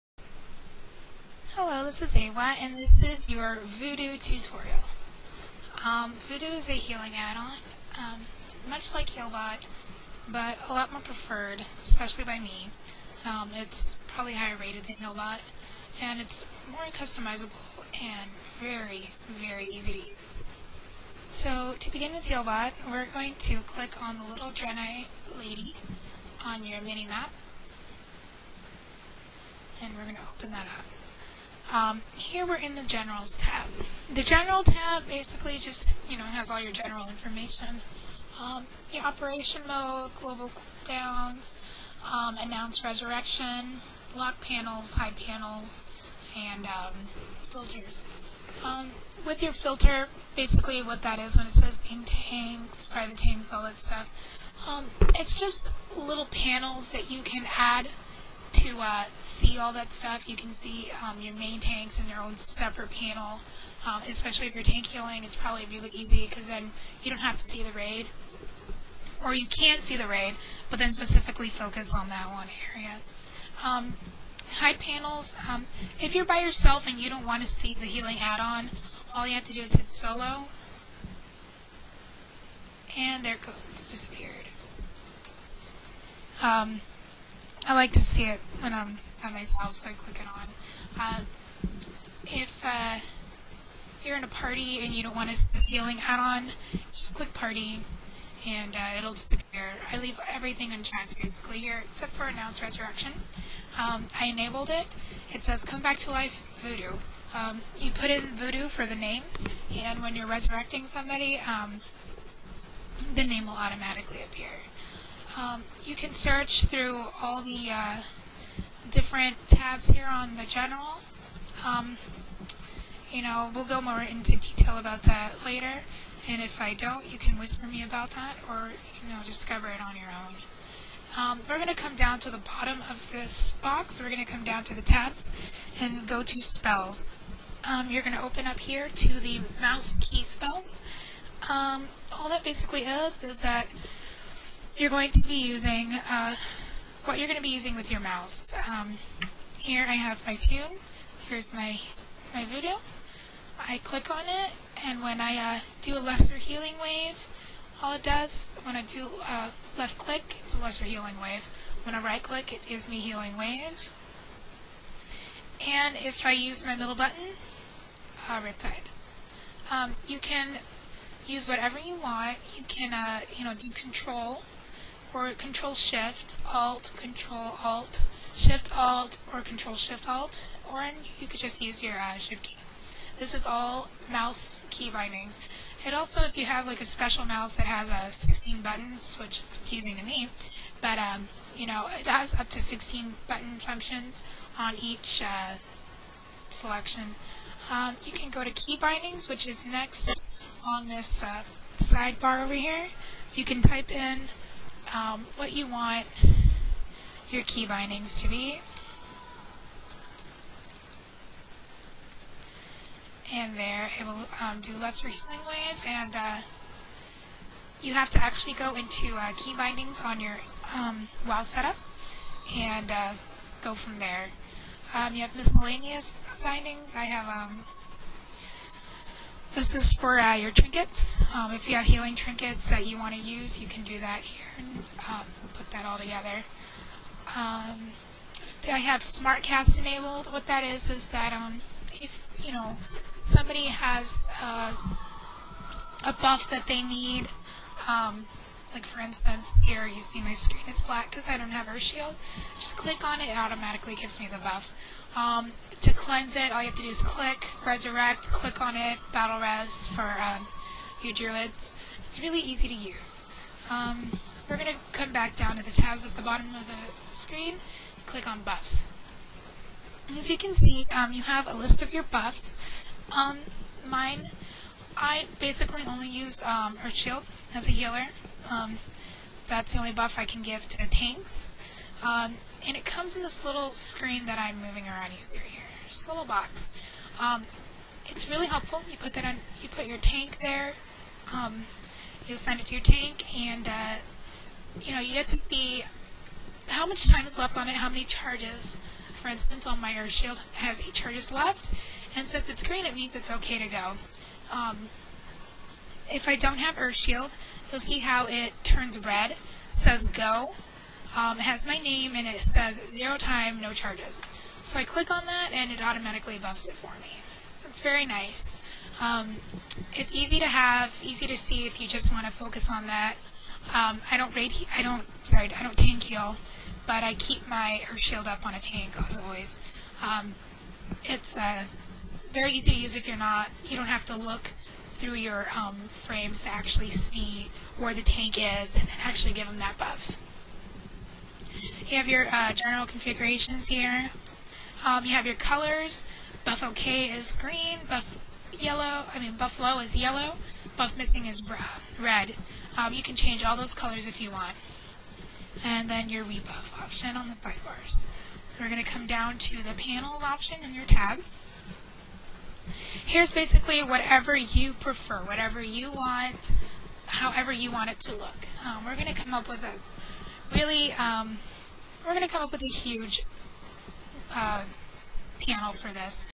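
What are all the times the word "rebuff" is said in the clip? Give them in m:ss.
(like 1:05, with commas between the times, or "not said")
5:56.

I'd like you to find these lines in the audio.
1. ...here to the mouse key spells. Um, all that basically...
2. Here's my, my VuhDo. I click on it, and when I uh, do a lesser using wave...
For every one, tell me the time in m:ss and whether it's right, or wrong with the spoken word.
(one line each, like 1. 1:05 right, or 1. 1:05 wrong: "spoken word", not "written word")
1. 2:18 right
2. 2:31 wrong: "healing", not "using".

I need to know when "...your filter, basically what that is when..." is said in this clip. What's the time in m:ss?
0:49.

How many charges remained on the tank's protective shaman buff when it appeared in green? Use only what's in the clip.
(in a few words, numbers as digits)
8.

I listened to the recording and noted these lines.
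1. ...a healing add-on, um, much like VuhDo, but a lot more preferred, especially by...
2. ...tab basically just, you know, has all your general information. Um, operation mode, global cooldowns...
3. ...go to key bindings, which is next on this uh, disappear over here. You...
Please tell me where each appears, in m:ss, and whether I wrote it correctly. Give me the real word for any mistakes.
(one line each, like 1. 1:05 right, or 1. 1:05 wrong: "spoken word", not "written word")
1. 0:06 wrong: "HealBot", not "VuhDo"
2. 0:34 right
3. 3:18 wrong: "sidebar", not "disappear".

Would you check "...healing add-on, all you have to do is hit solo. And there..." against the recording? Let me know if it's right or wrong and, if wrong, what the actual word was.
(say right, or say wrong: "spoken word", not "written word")
right.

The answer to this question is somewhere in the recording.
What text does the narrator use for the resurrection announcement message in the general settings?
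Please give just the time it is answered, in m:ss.
1:45.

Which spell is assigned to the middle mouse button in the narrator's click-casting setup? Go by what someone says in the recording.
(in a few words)
Riptide.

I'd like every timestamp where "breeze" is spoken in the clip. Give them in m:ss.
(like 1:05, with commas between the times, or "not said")
not said.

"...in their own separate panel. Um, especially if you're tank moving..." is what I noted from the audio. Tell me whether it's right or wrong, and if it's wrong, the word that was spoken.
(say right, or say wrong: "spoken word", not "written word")
wrong: "healing", not "moving".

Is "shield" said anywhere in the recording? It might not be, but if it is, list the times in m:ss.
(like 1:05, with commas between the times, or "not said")
4:11, 4:36, 5:00, 5:06, 5:27.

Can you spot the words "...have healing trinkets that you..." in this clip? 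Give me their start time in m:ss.
3:51.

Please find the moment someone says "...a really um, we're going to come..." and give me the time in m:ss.
6:09.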